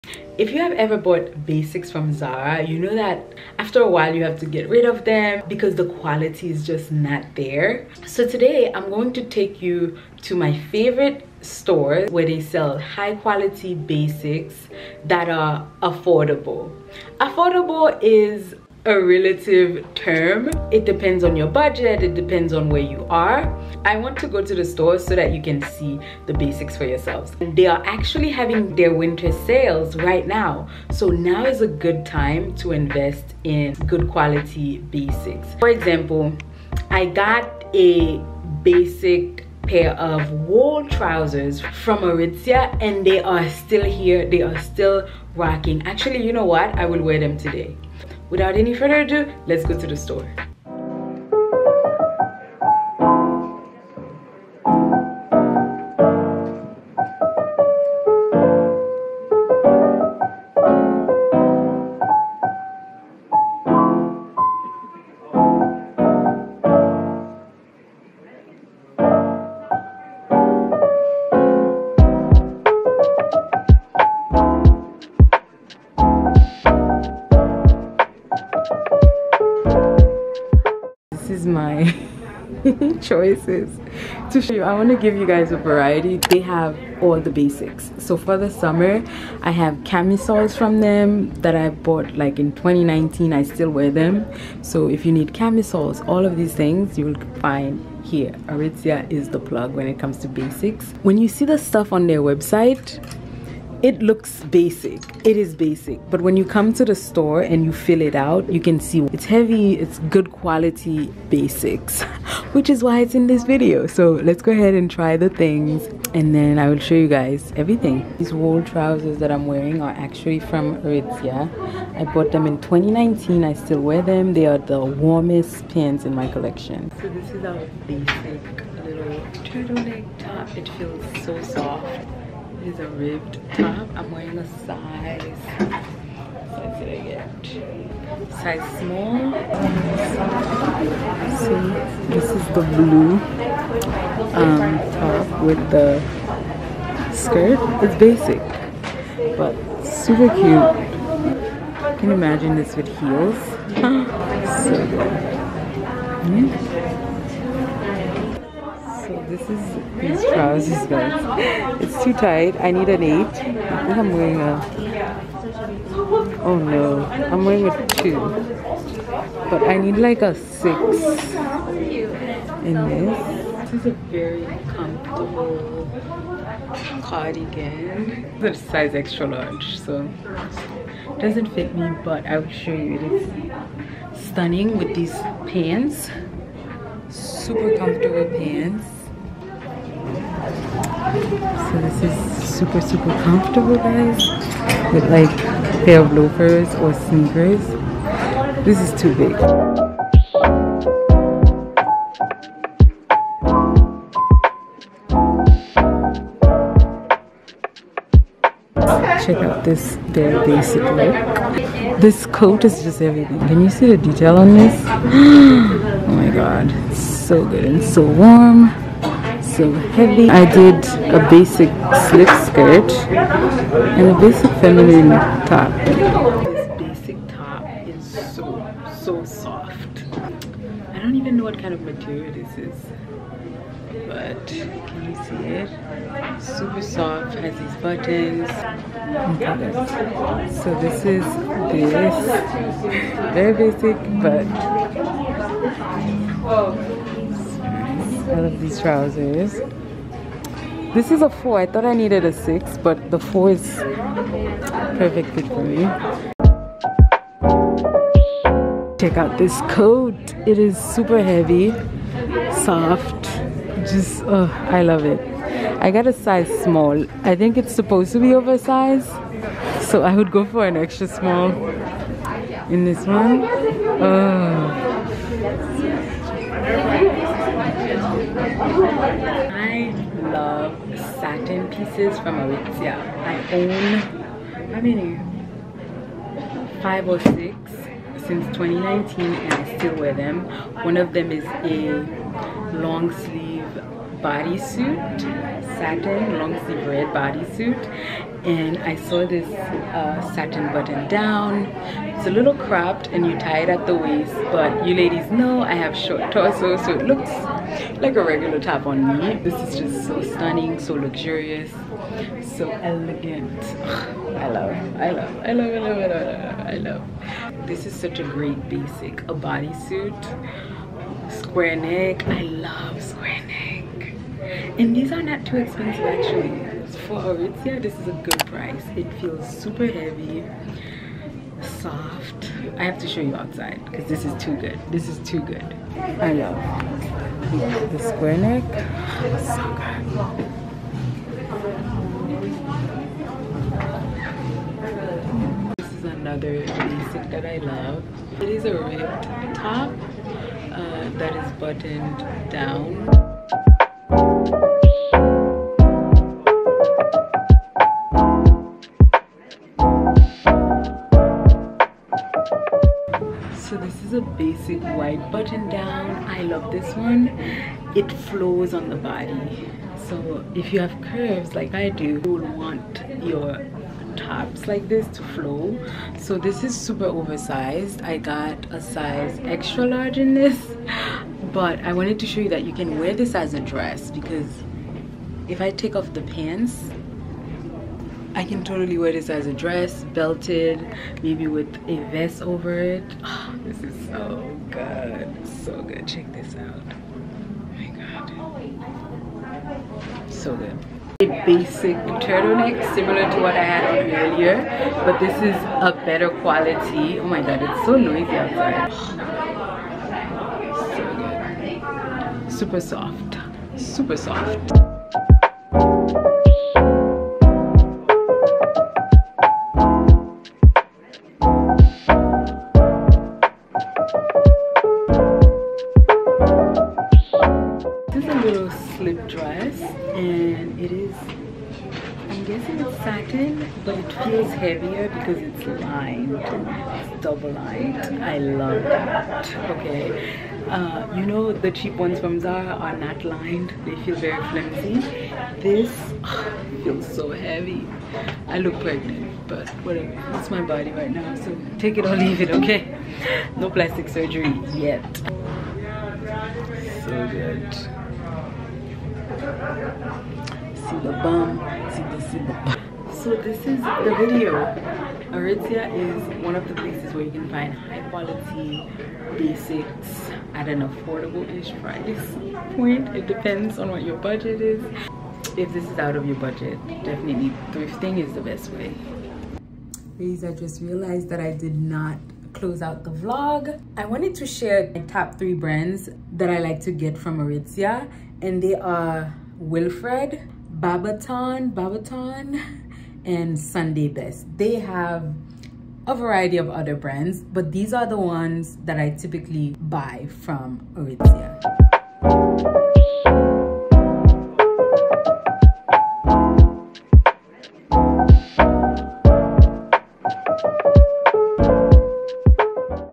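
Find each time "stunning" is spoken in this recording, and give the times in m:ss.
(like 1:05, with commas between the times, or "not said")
3:04, 5:10.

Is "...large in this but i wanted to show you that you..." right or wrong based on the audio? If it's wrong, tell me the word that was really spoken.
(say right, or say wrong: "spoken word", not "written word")
right.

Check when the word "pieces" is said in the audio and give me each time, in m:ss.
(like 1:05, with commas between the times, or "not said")
4:41.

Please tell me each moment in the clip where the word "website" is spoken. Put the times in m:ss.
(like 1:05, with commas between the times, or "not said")
1:42.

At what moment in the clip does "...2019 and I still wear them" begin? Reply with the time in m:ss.
4:48.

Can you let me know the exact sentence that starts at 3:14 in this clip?
With like a pair of loafers or sneakers.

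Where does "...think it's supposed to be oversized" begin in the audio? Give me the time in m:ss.
4:27.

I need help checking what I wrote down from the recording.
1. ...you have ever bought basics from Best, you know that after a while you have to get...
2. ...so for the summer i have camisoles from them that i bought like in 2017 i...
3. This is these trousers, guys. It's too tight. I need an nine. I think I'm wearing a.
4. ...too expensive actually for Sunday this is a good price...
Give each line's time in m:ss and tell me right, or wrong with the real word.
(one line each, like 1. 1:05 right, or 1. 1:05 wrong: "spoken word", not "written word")
1. 0:00 wrong: "Zara", not "Best"
2. 1:27 wrong: "2019", not "2017"
3. 2:39 wrong: "eight", not "nine"
4. 5:25 wrong: "Aritzia", not "Sunday".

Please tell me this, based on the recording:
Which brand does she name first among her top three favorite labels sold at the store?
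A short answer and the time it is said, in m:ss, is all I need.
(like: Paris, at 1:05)
Wilfred, at 8:09.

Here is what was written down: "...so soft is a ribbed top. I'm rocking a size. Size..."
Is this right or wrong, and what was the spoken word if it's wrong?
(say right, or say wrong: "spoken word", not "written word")
wrong: "wearing", not "rocking".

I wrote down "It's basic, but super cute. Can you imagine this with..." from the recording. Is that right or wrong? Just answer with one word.
right.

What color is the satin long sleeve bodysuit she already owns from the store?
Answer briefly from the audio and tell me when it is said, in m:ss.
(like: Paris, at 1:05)
Red, at 4:56.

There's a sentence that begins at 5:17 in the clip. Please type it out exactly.
This is such a great basic, a bodysuit, square neck.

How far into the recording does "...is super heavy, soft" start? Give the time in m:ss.
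4:20.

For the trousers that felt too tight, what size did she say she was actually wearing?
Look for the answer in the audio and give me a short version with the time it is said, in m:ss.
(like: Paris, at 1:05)
2, at 2:47.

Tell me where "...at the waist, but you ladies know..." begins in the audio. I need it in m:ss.
5:03.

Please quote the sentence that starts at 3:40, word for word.
I did a basic slip skirt and a basic feminine top.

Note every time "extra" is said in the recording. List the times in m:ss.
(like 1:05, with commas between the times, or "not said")
2:58, 4:30, 6:19.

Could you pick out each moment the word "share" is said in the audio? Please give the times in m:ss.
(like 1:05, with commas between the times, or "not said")
8:04.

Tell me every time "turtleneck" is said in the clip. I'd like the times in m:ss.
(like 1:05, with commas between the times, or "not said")
2:09, 6:42.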